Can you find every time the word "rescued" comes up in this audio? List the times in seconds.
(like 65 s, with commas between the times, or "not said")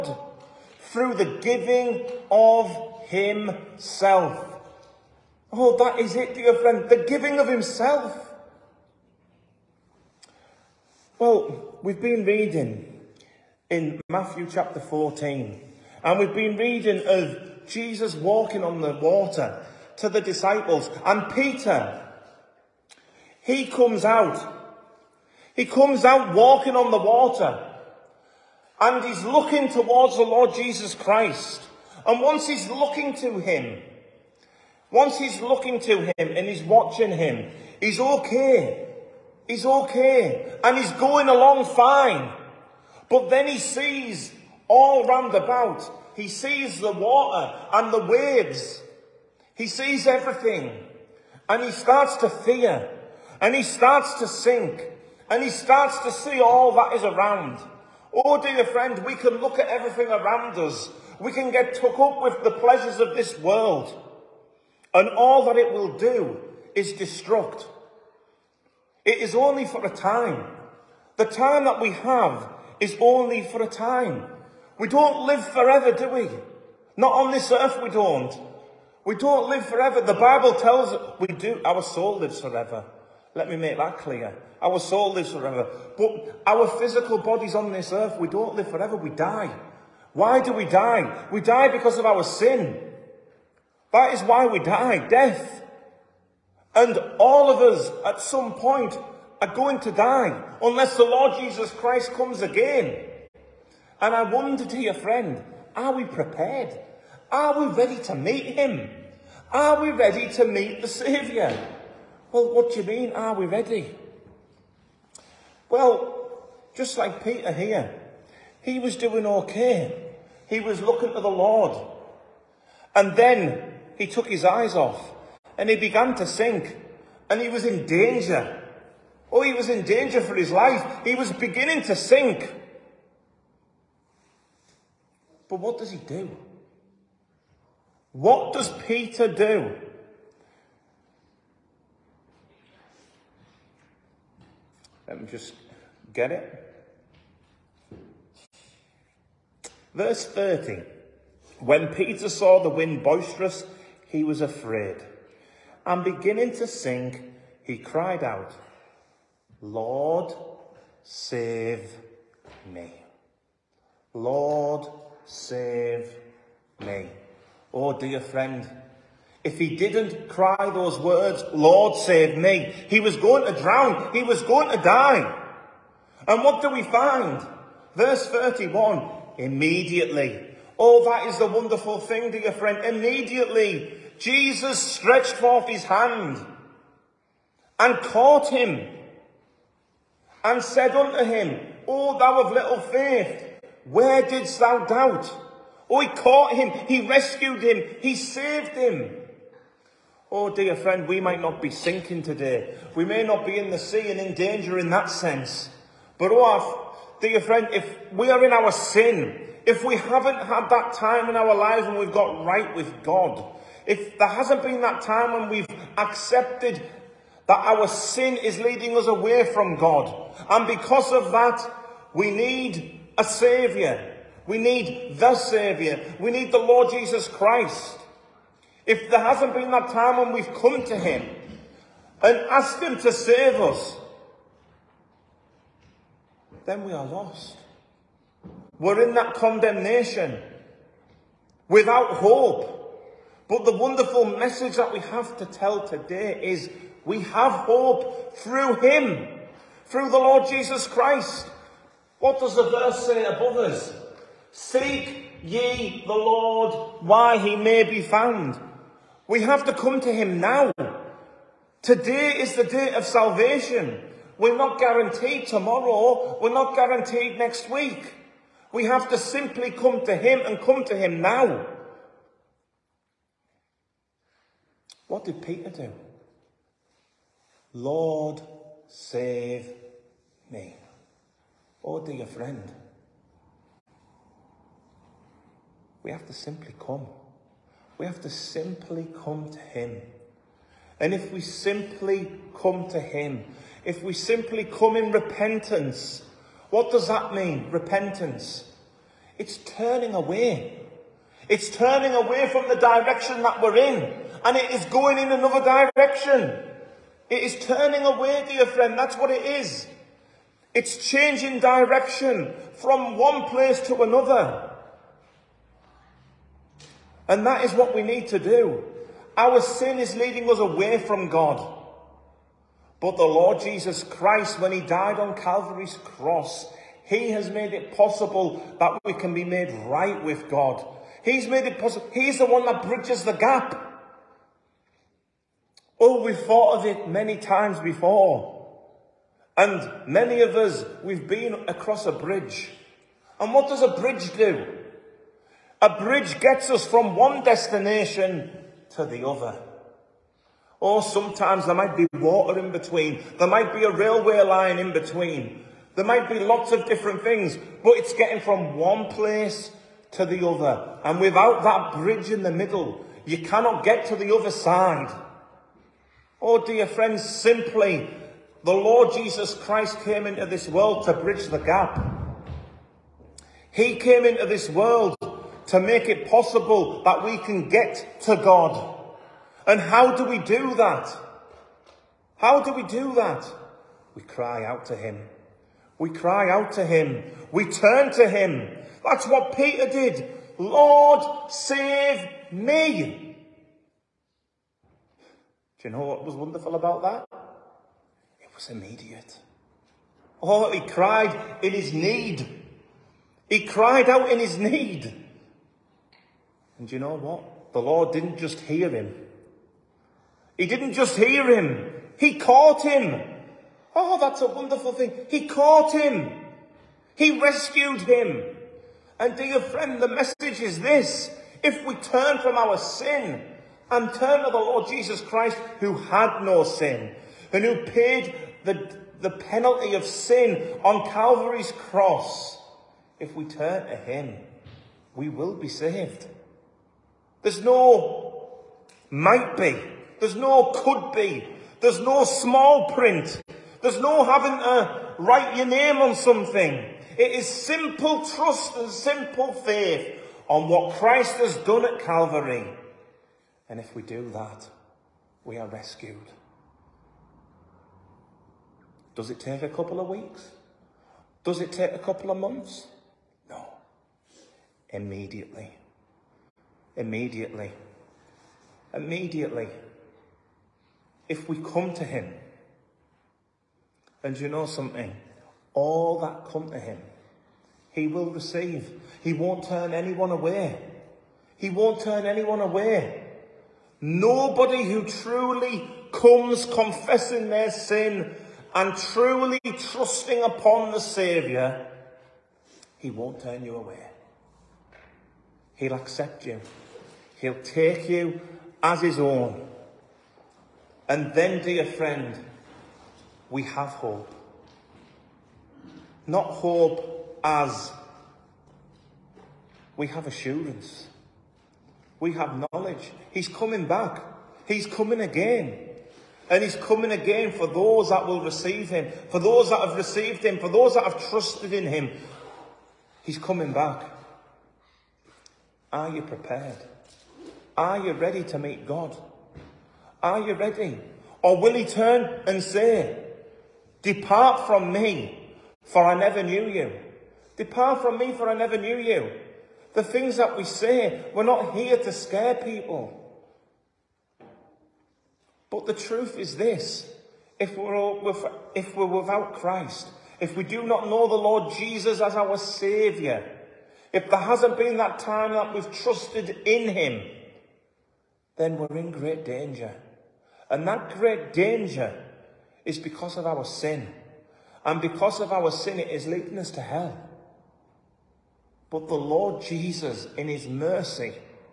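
197 s, 417 s, 455 s.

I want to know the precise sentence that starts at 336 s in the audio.
Oh, we've thought of it many times before.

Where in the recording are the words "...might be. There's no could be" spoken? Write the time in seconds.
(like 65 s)
439 s.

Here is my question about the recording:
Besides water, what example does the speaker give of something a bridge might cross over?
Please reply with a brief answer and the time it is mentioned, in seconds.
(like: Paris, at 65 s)
A railway line, at 353 s.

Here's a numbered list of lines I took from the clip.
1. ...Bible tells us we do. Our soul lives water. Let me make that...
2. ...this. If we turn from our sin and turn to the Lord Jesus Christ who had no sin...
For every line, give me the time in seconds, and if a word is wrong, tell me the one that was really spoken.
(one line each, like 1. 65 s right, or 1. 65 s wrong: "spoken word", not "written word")
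1. 80 s wrong: "forever", not "water"
2. 420 s right.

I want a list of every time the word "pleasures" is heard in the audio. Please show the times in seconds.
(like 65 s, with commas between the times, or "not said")
62 s.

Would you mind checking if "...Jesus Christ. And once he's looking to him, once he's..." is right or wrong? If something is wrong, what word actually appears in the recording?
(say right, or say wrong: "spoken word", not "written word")
right.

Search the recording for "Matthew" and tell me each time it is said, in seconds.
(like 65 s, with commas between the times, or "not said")
14 s.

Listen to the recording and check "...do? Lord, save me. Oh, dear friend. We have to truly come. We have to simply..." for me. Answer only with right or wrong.
wrong.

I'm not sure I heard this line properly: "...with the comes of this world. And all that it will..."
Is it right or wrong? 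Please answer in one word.
wrong.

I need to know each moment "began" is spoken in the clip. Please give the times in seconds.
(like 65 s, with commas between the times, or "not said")
125 s.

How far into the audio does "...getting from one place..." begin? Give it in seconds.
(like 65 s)
358 s.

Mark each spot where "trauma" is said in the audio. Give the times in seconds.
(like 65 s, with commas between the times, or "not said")
not said.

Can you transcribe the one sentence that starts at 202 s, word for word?
We may not be in the sea and in danger in that sense.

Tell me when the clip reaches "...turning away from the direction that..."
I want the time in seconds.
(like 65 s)
301 s.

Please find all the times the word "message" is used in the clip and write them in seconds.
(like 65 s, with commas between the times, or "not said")
244 s, 420 s.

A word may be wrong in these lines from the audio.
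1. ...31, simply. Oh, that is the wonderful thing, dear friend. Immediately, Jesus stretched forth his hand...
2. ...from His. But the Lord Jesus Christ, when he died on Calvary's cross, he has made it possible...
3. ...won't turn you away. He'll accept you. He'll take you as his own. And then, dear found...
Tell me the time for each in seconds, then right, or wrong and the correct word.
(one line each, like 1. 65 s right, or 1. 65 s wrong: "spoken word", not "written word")
1. 178 s wrong: "immediately", not "simply"
2. 320 s wrong: "God", not "His"
3. 493 s wrong: "friend", not "found".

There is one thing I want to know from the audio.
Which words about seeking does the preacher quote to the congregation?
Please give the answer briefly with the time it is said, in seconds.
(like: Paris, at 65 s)
Seek ye the Lord, at 254 s.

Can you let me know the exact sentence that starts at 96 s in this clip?
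And all of us at some point are going to die unless the Lord Jesus Christ comes again.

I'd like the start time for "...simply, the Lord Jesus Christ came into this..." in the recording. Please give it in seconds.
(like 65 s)
367 s.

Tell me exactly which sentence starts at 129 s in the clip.
Oh, he was in danger for his life.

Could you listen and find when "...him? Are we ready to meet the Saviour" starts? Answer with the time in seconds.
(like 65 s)
108 s.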